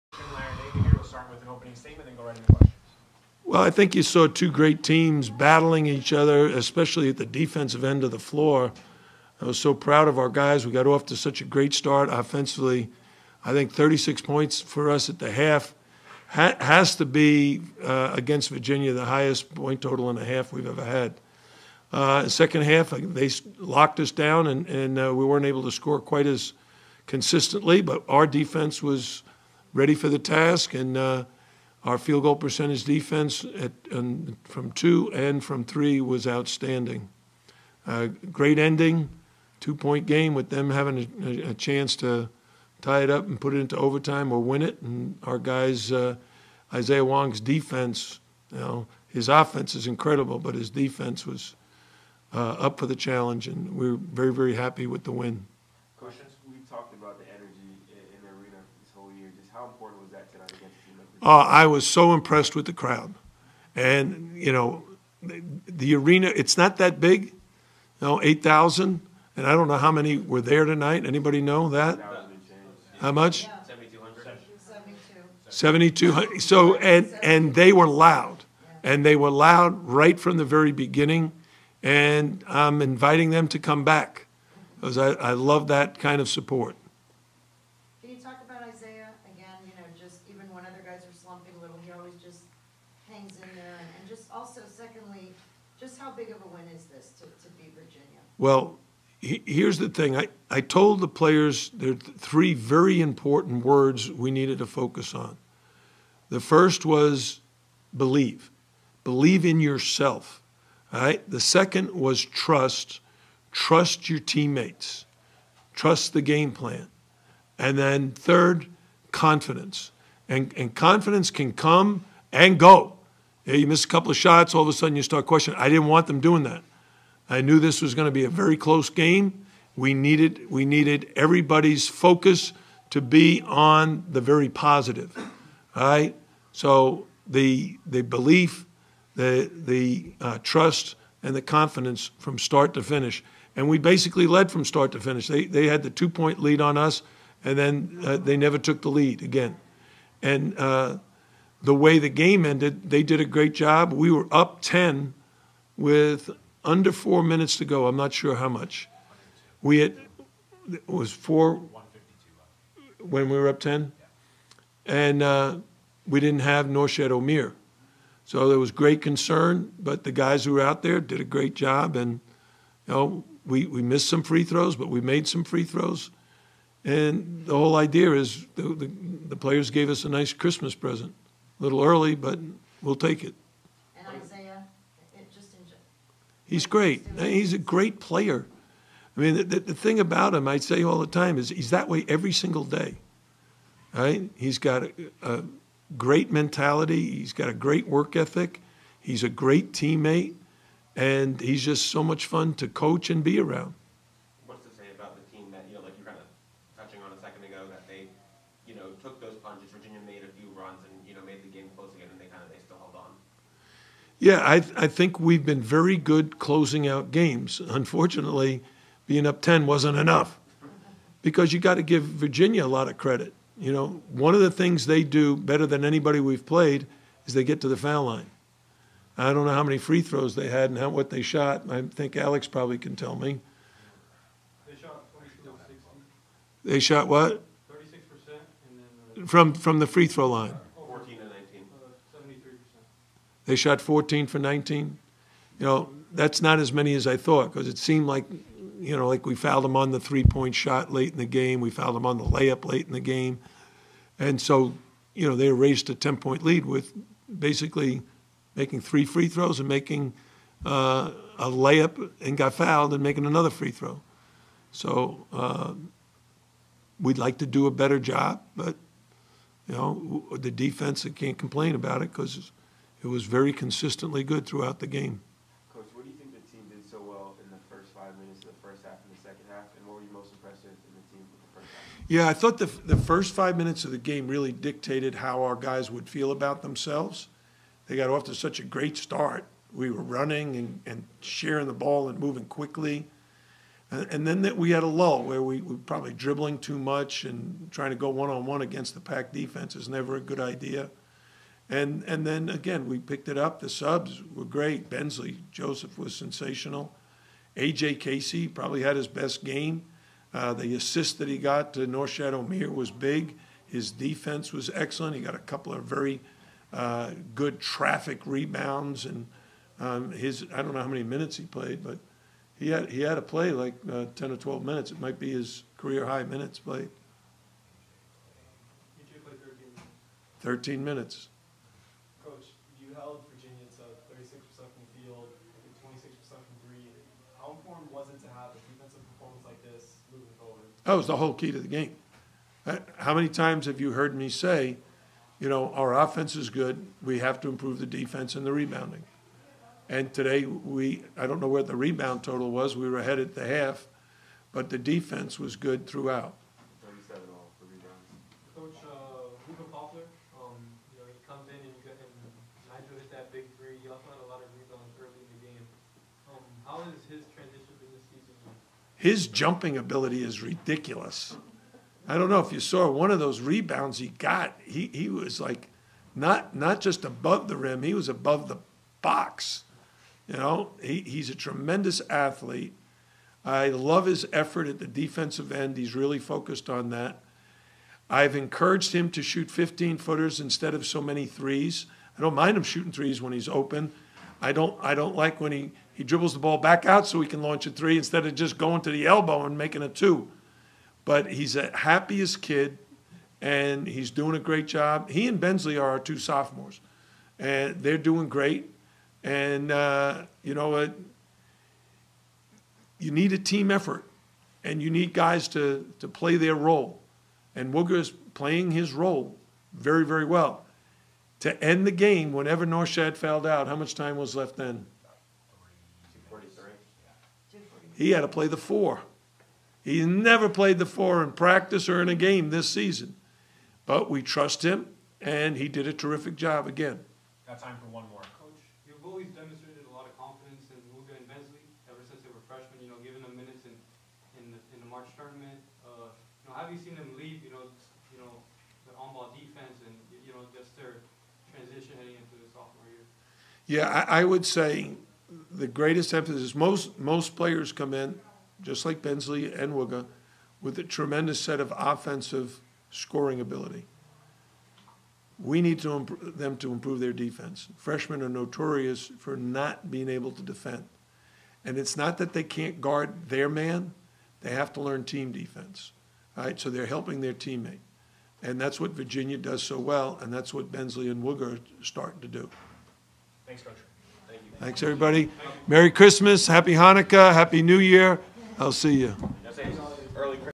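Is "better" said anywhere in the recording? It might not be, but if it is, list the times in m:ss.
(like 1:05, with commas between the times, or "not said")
3:45, 4:27.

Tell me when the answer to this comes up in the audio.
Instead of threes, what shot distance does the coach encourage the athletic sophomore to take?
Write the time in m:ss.
6:29.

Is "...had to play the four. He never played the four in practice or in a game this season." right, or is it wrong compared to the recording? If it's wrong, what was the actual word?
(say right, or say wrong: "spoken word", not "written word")
right.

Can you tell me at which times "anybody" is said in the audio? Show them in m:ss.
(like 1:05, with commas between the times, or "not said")
1:11, 3:45.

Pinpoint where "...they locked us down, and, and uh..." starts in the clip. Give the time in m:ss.
0:23.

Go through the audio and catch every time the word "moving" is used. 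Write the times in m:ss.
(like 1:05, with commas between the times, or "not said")
4:52, 5:40.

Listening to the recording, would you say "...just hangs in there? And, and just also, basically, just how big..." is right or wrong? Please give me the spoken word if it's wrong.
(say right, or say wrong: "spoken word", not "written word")
wrong: "secondly", not "basically".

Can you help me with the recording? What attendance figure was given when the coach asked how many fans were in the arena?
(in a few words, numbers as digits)
7,200.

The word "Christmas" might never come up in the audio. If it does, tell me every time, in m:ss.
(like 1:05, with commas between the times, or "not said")
3:00, 8:05.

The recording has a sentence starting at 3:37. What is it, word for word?
Unfortunately, being up 10 wasn't enough because you got to give Virginia a lot of credit.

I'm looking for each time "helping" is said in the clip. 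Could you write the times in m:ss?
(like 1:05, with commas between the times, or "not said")
7:56.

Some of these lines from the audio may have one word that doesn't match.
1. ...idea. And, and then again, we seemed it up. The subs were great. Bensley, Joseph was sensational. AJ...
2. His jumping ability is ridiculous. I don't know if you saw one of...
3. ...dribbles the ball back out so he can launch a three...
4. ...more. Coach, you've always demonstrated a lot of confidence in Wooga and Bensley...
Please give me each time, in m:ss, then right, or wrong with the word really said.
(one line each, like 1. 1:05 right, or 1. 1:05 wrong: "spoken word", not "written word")
1. 5:00 wrong: "picked", not "seemed"
2. 6:09 right
3. 6:36 right
4. 7:18 right.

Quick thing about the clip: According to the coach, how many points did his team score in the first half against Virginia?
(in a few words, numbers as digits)
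36.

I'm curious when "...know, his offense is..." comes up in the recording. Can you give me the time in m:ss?
0:48.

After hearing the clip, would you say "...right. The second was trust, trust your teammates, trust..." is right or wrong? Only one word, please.
right.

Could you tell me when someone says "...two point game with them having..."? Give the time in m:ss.
0:39.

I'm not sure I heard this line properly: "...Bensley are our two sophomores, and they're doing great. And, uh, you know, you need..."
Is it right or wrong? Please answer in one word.
right.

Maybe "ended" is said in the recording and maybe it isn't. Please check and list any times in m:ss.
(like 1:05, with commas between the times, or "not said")
2:32.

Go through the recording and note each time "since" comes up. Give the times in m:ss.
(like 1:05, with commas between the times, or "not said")
7:22.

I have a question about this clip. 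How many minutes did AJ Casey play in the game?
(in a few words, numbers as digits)
13.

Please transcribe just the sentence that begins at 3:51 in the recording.
I think Alex probably can tell me.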